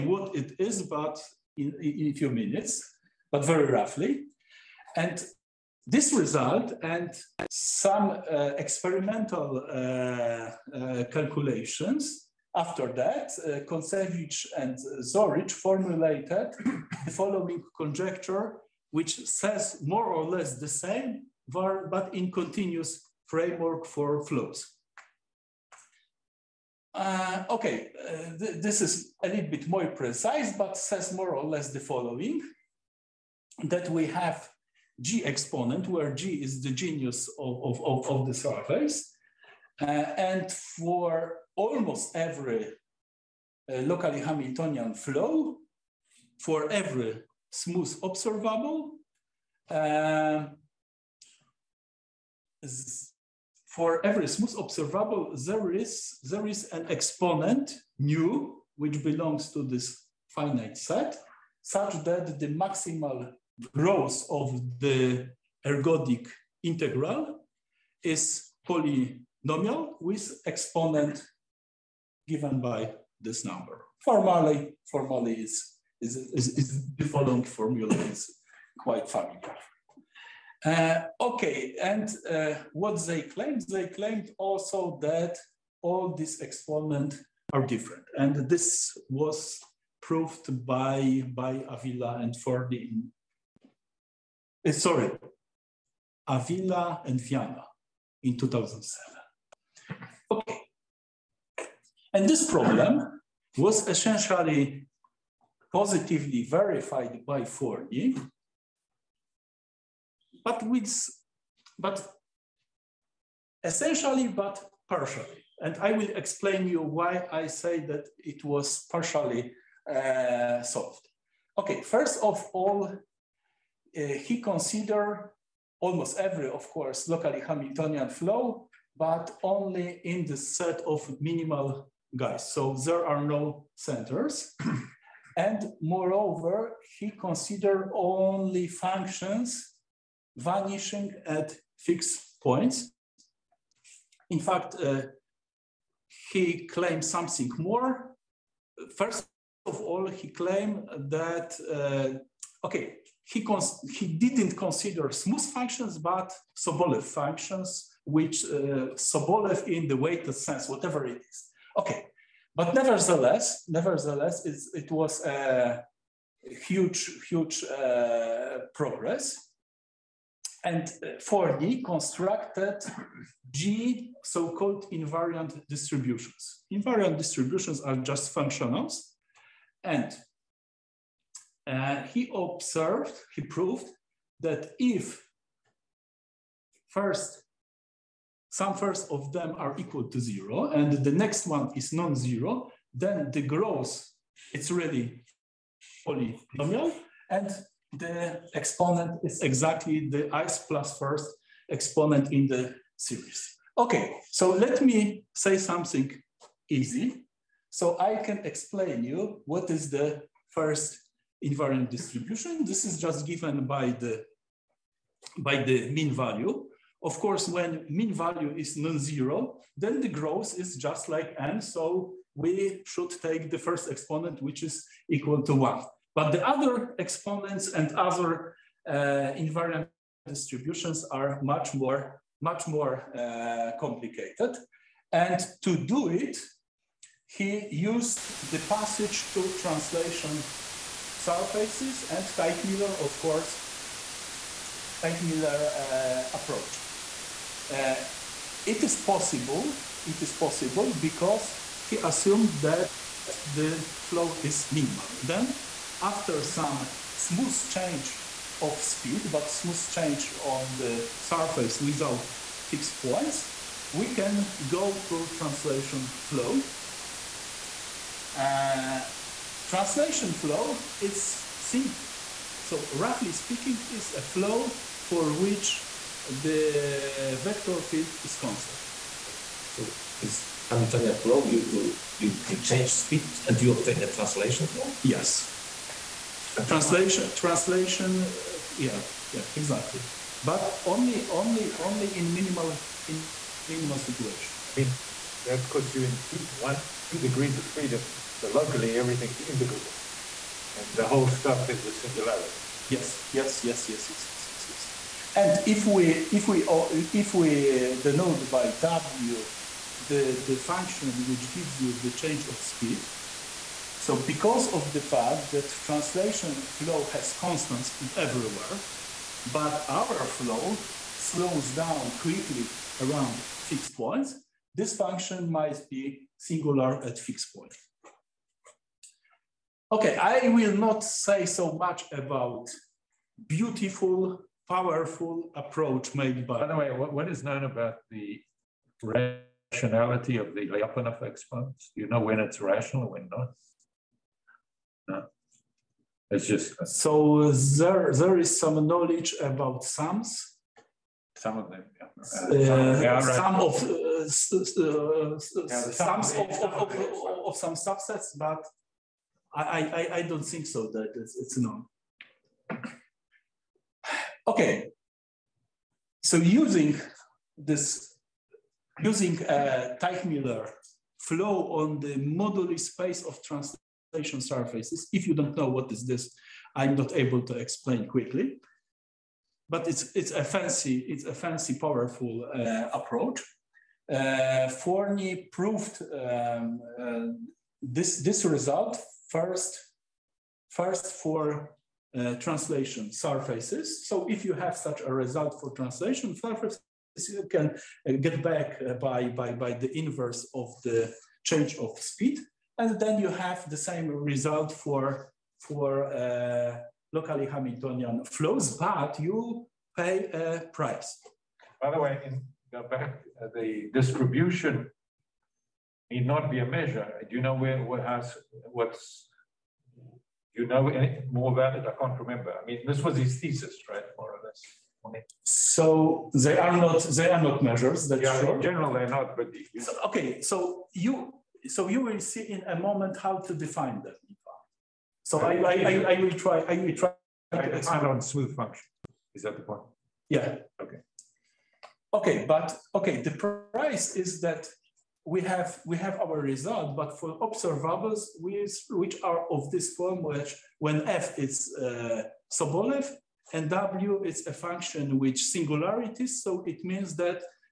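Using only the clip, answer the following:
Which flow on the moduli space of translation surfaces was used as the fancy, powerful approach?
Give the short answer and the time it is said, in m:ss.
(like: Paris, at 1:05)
Teichmuller flow, at 6:09.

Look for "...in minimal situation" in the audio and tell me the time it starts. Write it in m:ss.
4:53.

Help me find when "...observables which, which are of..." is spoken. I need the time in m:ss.
7:27.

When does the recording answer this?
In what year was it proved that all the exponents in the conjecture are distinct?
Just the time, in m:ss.
1:38.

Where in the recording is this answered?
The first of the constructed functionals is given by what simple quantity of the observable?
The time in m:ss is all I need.
3:35.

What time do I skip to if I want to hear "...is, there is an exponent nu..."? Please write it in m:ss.
0:55.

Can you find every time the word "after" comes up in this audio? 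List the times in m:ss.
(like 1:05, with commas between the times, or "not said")
0:12, 4:16.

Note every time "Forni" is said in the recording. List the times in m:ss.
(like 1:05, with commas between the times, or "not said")
1:32, 1:47, 2:51, 6:24.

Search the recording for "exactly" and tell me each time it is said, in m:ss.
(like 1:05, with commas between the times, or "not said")
3:19, 4:49.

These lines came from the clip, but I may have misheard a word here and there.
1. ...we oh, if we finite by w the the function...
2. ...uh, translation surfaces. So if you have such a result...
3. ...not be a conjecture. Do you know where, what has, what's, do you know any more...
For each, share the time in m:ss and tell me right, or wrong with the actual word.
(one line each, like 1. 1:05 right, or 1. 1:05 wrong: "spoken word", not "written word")
1. 5:06 wrong: "denote", not "finite"
2. 6:32 right
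3. 6:56 wrong: "measure", not "conjecture".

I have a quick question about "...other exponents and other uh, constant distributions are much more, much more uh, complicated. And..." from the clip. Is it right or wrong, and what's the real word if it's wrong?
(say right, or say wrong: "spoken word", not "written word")
wrong: "invariant", not "constant".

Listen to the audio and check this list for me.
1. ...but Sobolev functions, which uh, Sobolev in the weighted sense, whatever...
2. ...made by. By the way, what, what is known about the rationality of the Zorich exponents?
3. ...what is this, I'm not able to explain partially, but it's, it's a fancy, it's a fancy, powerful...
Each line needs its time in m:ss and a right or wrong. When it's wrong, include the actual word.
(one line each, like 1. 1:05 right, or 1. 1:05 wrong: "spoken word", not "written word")
1. 2:35 right
2. 5:36 wrong: "Lyapunov", not "Zorich"
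3. 6:15 wrong: "quickly", not "partially".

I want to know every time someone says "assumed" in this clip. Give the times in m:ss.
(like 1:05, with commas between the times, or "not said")
4:11.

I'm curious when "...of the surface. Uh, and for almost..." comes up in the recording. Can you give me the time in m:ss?
0:38.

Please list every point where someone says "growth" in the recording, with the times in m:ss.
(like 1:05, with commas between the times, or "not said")
1:03, 3:13, 3:40.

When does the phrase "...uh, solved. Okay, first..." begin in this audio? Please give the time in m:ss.
1:59.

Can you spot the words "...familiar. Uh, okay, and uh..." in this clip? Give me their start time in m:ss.
1:19.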